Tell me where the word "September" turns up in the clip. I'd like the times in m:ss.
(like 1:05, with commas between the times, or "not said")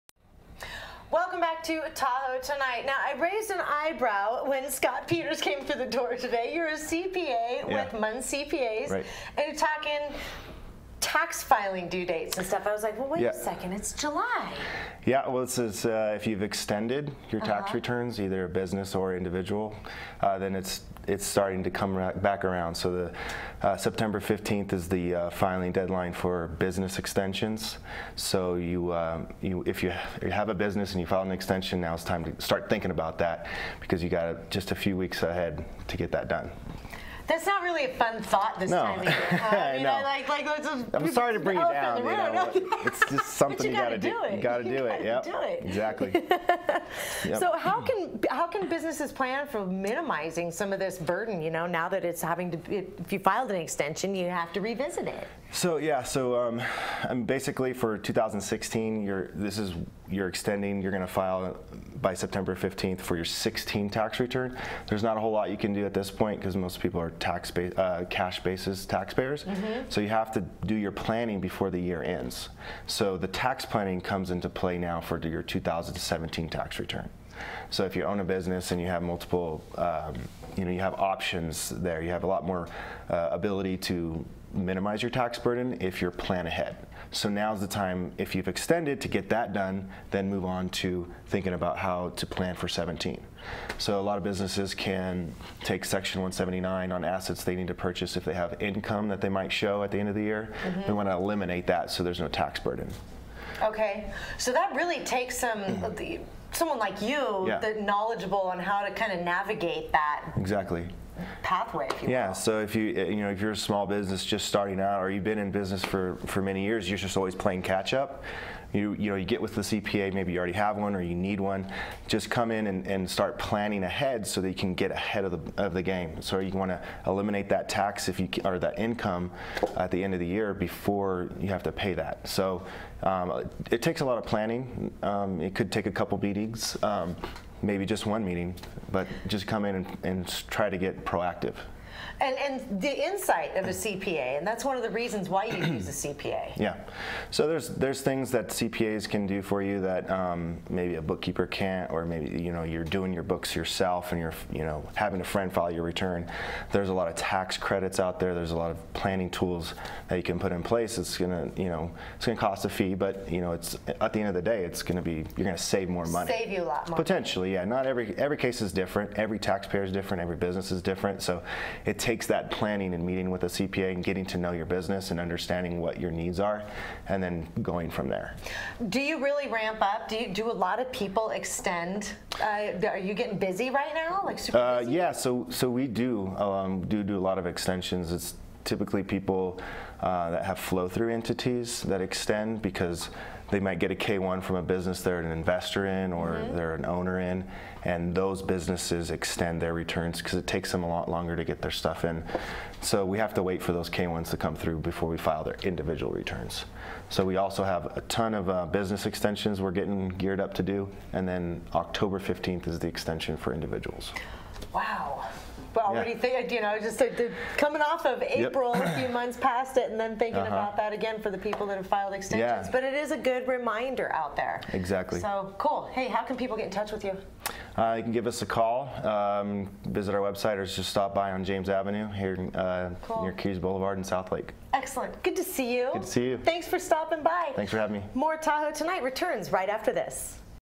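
0:23, 1:02.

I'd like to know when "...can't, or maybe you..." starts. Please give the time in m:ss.
2:31.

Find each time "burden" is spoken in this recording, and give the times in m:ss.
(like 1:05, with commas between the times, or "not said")
0:50, 1:25, 1:42.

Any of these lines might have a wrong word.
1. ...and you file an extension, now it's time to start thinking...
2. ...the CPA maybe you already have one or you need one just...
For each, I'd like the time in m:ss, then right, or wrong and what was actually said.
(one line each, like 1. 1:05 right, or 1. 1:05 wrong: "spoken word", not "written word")
1. 0:30 right
2. 1:59 right.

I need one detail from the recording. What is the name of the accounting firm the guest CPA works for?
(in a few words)
Munn CPAs.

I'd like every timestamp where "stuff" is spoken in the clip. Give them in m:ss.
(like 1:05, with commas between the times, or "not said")
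0:12, 3:21.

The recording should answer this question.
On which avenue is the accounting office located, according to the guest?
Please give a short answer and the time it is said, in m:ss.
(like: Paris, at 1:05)
James Avenue, at 3:51.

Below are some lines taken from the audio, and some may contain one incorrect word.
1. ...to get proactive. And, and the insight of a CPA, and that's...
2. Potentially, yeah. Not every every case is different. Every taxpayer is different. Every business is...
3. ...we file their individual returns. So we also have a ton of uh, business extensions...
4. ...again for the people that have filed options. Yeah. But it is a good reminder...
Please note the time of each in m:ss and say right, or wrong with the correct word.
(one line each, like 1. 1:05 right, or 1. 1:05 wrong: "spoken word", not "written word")
1. 2:20 right
2. 2:46 right
3. 3:25 right
4. 3:40 wrong: "extensions", not "options".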